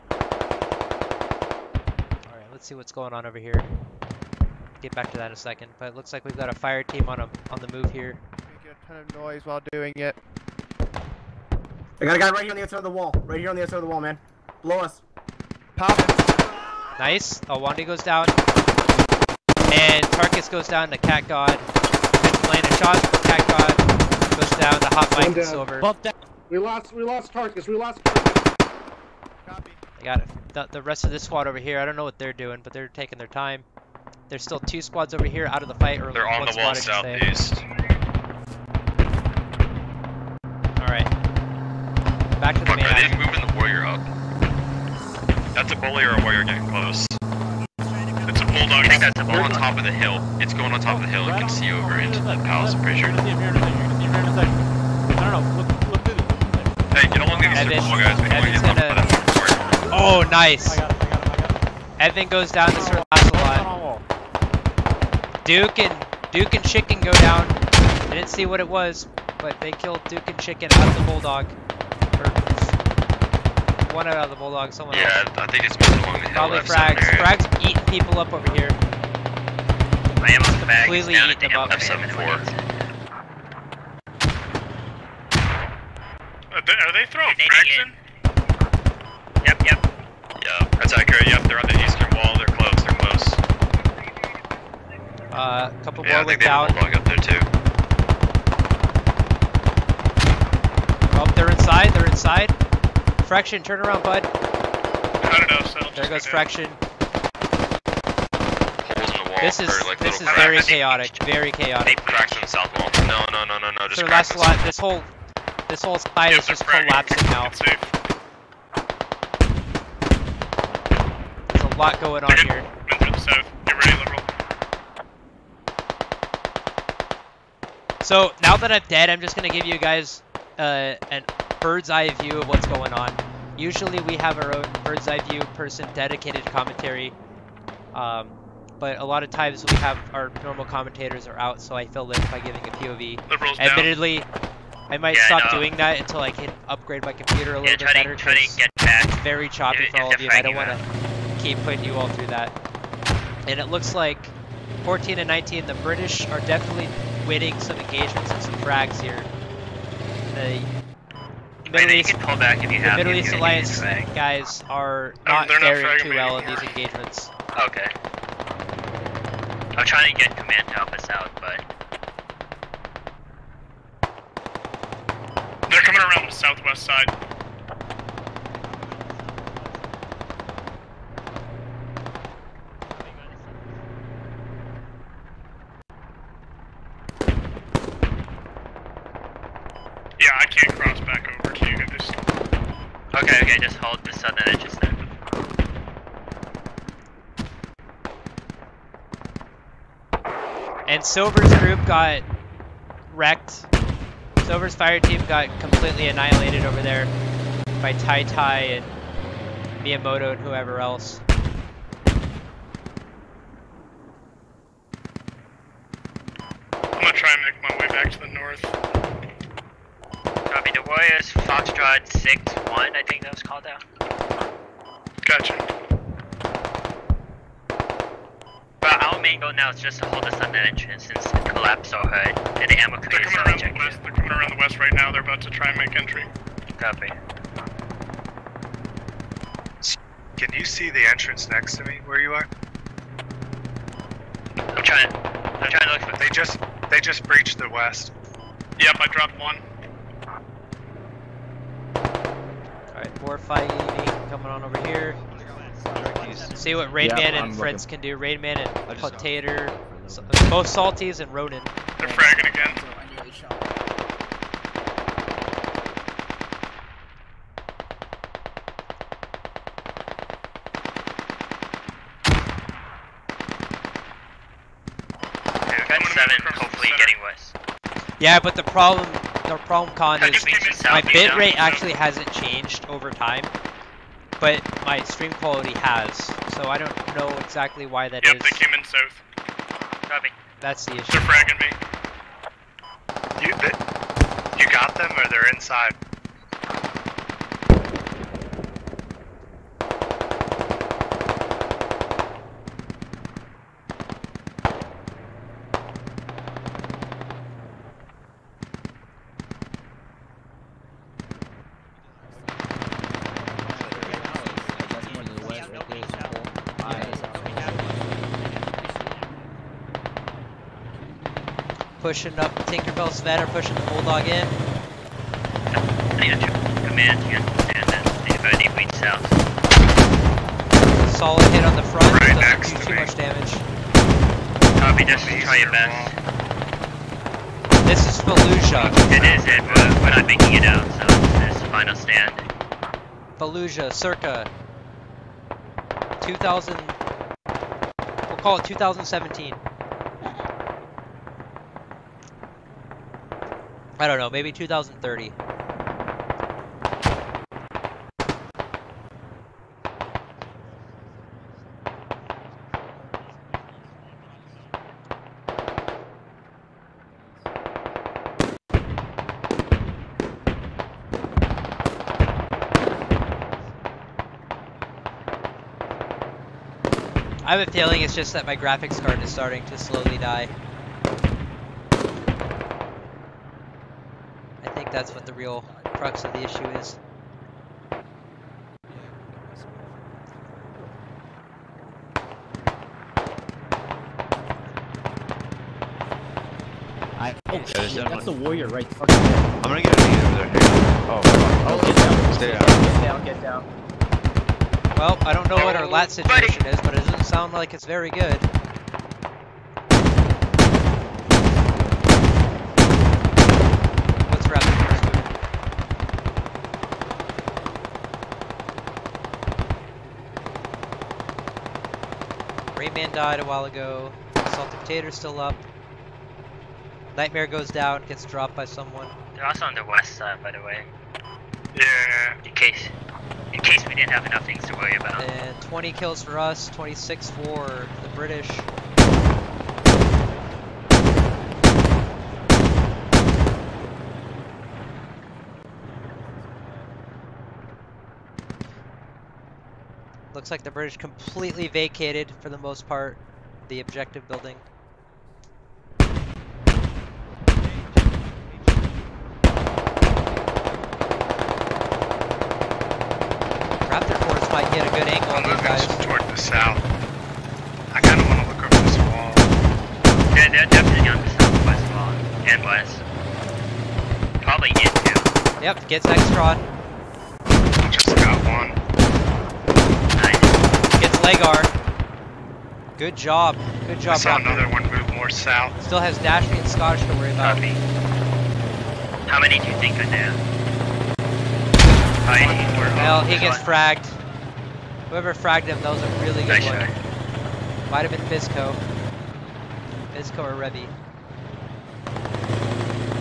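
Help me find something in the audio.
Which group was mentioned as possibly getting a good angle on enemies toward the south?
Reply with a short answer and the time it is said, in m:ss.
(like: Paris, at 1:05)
Raptor Force, at 7:43.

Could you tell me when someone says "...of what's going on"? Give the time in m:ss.
2:12.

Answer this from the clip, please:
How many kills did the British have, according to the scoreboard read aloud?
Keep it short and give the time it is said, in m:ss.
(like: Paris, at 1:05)
26, at 7:16.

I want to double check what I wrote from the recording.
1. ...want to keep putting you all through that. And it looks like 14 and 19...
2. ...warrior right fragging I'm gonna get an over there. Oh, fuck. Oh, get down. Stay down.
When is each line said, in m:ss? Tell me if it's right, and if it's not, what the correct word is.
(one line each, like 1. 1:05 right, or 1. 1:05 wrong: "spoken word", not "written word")
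1. 2:30 right
2. 6:38 wrong: "fucking", not "fragging".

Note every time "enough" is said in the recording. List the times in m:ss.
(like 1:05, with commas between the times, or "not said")
7:14.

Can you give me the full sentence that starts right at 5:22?
pushing up Tinkerbell, Sven are pushing the Bulldog in.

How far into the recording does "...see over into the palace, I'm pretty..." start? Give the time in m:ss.
0:51.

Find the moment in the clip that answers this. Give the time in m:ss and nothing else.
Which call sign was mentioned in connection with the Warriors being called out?
3:41.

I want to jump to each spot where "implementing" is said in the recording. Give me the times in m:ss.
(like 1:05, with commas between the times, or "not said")
not said.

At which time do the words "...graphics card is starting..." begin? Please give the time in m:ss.
6:18.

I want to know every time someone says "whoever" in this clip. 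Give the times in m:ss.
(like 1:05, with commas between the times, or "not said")
3:30, 8:15.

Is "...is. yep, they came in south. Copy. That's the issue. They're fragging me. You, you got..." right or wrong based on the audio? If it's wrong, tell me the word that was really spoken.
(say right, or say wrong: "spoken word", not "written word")
right.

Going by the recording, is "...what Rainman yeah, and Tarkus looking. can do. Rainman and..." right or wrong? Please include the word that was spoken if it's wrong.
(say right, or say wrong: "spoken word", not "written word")
wrong: "Friends", not "Tarkus".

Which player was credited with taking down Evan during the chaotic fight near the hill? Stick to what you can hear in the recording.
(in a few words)
Sir Ocelot.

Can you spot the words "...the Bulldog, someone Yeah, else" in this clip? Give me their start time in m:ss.
1:14.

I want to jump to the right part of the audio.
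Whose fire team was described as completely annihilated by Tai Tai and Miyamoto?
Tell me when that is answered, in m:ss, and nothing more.
3:24.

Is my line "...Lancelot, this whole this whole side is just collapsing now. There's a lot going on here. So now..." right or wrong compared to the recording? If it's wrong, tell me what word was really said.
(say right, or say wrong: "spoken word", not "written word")
right.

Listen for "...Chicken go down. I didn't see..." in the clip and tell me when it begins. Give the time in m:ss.
1:06.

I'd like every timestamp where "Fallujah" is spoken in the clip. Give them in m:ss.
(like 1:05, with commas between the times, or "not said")
5:38, 5:43.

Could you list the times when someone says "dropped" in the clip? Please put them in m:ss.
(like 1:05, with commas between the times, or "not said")
4:09, 7:08.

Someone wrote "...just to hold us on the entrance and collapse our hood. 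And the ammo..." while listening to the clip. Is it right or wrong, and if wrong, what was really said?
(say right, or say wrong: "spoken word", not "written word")
right.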